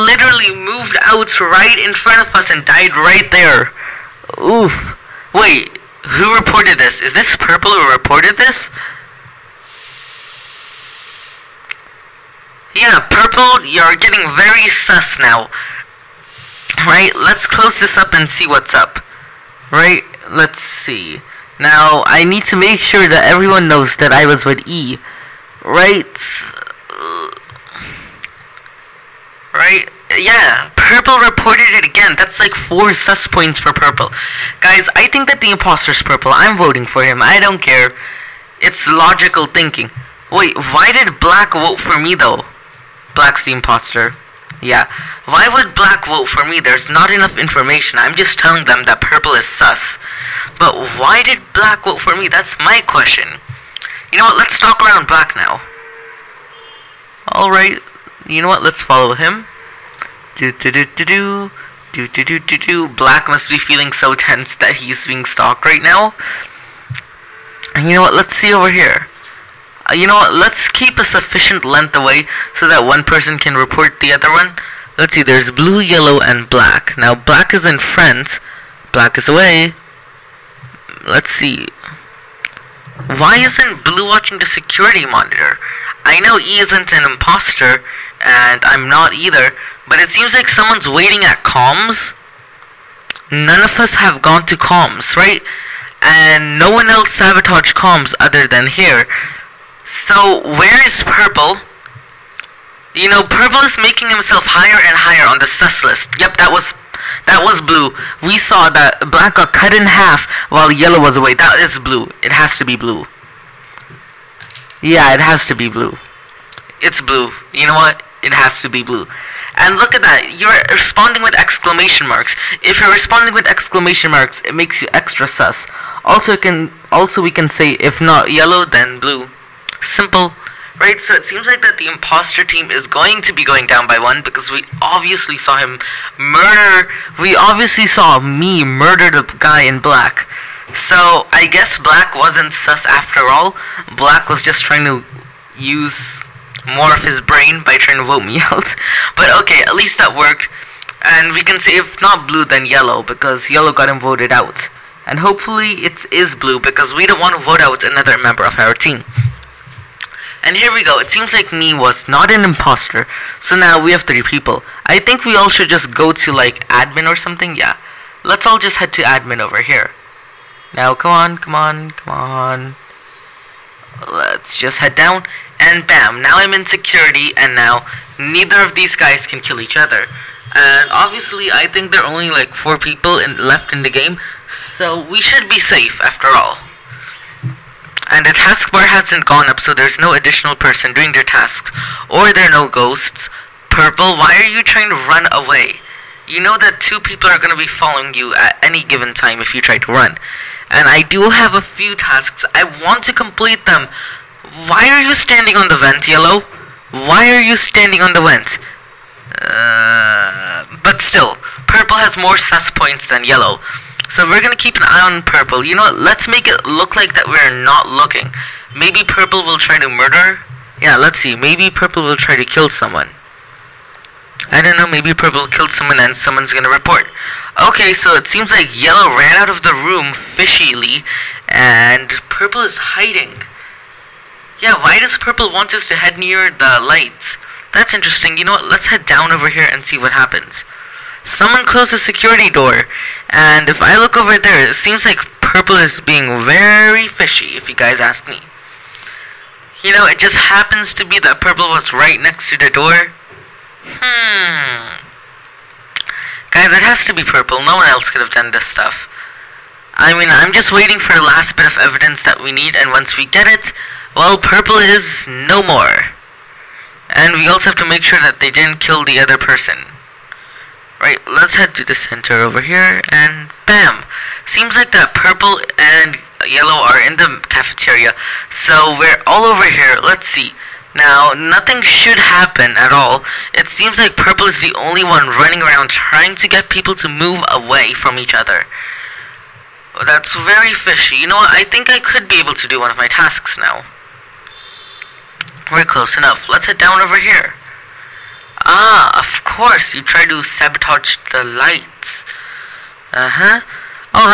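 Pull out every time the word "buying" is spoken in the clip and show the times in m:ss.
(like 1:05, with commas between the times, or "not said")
not said.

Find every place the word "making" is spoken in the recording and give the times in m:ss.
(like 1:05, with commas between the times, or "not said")
1:43.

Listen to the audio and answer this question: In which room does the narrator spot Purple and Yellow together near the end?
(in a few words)
cafeteria.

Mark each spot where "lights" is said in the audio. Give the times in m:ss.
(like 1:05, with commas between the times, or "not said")
3:56, 5:01.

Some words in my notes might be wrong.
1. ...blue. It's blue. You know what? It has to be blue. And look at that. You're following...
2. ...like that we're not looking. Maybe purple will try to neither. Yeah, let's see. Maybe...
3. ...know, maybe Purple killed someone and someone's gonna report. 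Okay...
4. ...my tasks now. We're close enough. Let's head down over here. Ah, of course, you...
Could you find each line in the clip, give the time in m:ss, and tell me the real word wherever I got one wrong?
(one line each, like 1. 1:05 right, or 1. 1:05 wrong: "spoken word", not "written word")
1. 1:55 wrong: "responding", not "following"
2. 3:36 wrong: "murder", not "neither"
3. 3:44 right
4. 4:52 right.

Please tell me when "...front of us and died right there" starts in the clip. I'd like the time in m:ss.
0:01.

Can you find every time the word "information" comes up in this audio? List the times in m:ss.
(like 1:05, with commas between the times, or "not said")
0:47.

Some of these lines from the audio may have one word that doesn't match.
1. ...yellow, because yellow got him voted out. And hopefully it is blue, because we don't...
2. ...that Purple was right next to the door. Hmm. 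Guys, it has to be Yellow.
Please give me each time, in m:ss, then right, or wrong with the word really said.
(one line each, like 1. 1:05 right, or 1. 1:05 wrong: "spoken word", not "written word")
1. 2:32 right
2. 4:11 wrong: "Purple", not "Yellow".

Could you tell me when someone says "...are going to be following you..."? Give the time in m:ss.
3:17.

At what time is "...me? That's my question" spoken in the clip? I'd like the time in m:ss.
0:52.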